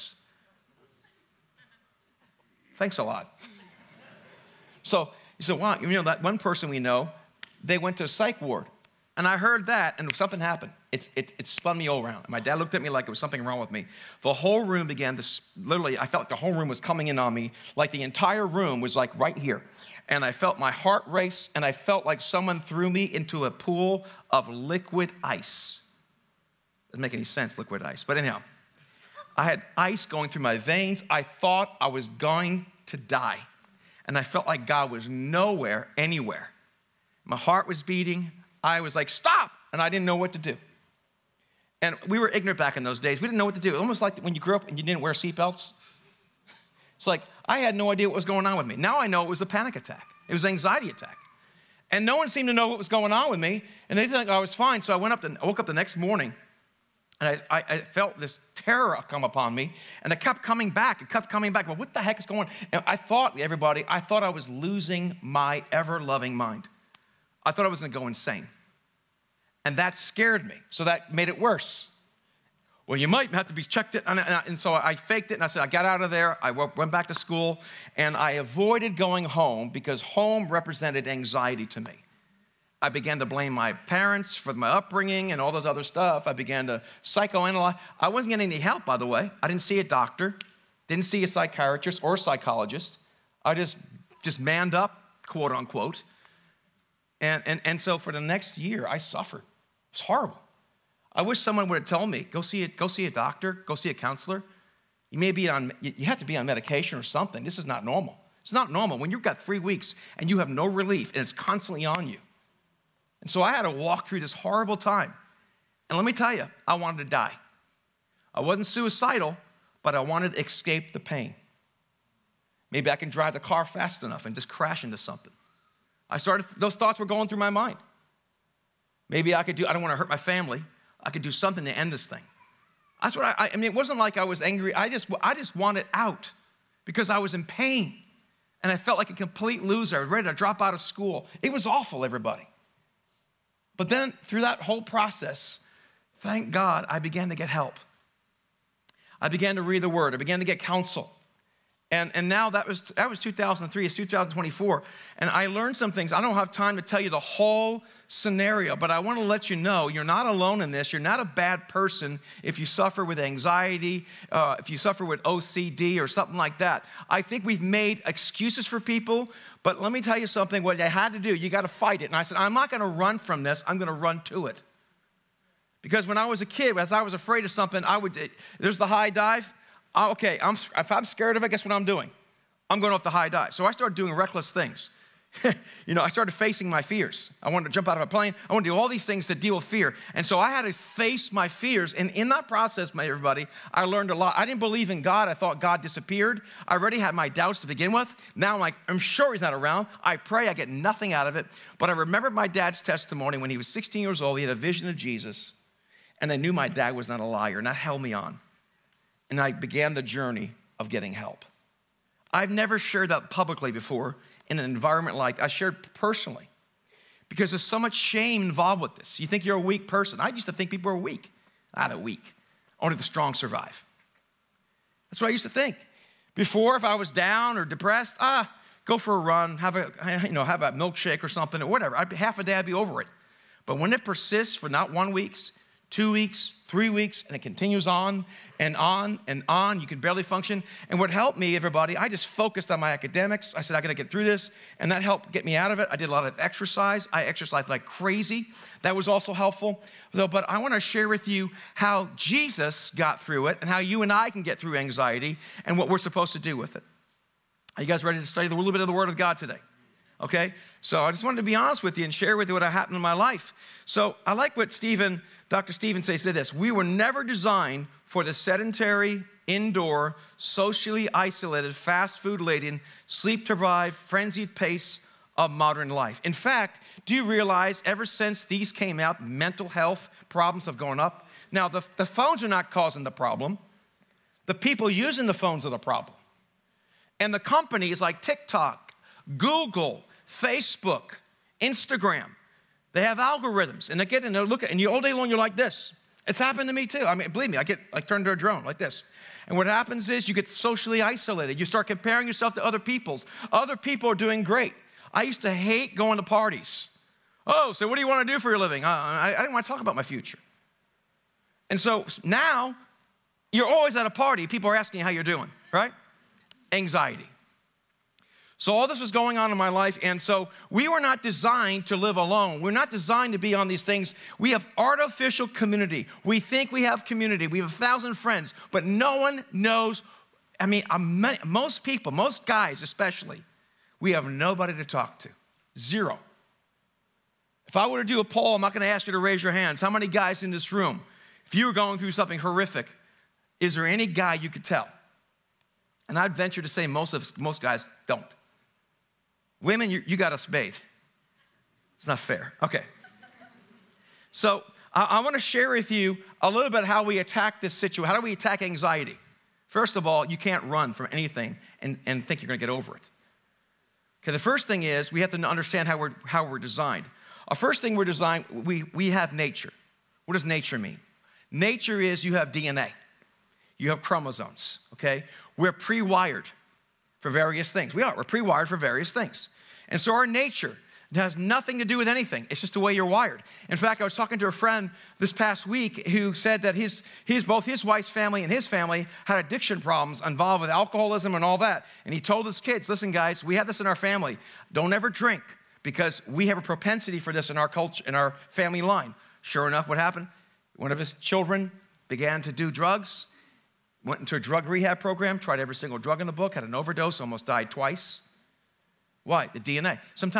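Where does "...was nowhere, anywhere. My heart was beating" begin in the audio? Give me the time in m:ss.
0:34.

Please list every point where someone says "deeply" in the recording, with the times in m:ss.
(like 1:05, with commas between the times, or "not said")
not said.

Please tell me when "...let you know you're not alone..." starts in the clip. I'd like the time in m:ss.
2:39.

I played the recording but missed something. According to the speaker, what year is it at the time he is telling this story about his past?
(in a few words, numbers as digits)
2024.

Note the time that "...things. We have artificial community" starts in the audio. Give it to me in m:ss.
5:23.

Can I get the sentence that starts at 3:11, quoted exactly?
And in that process, my everybody, I learned a lot.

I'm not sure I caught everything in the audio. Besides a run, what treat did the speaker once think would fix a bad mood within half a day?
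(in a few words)
A milkshake.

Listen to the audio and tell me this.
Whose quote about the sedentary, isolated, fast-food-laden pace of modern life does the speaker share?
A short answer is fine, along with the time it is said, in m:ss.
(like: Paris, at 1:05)
Dr. Stevenson, at 4:25.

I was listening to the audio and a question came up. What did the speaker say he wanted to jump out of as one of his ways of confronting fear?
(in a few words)
A plane.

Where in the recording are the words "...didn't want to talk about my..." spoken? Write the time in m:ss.
5:09.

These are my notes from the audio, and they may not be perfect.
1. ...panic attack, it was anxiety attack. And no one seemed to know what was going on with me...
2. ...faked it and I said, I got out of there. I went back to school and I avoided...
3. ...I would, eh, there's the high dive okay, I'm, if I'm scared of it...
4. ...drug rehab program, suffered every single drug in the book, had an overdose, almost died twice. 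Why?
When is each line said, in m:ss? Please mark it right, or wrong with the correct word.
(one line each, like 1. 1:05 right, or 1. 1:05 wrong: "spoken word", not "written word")
1. 0:49 right
2. 1:14 right
3. 2:57 right
4. 6:44 wrong: "tried", not "suffered".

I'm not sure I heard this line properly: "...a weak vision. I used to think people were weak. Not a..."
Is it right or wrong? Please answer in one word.
wrong.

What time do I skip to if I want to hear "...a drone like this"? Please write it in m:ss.
4:58.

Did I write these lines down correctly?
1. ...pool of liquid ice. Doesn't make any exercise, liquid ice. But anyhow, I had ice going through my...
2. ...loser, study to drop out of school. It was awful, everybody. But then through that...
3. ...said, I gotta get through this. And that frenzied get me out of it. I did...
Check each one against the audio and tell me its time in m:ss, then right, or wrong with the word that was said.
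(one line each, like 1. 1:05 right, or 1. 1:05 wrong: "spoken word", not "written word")
1. 0:23 wrong: "sense", not "exercise"
2. 2:19 wrong: "ready", not "study"
3. 4:03 wrong: "helped", not "frenzied".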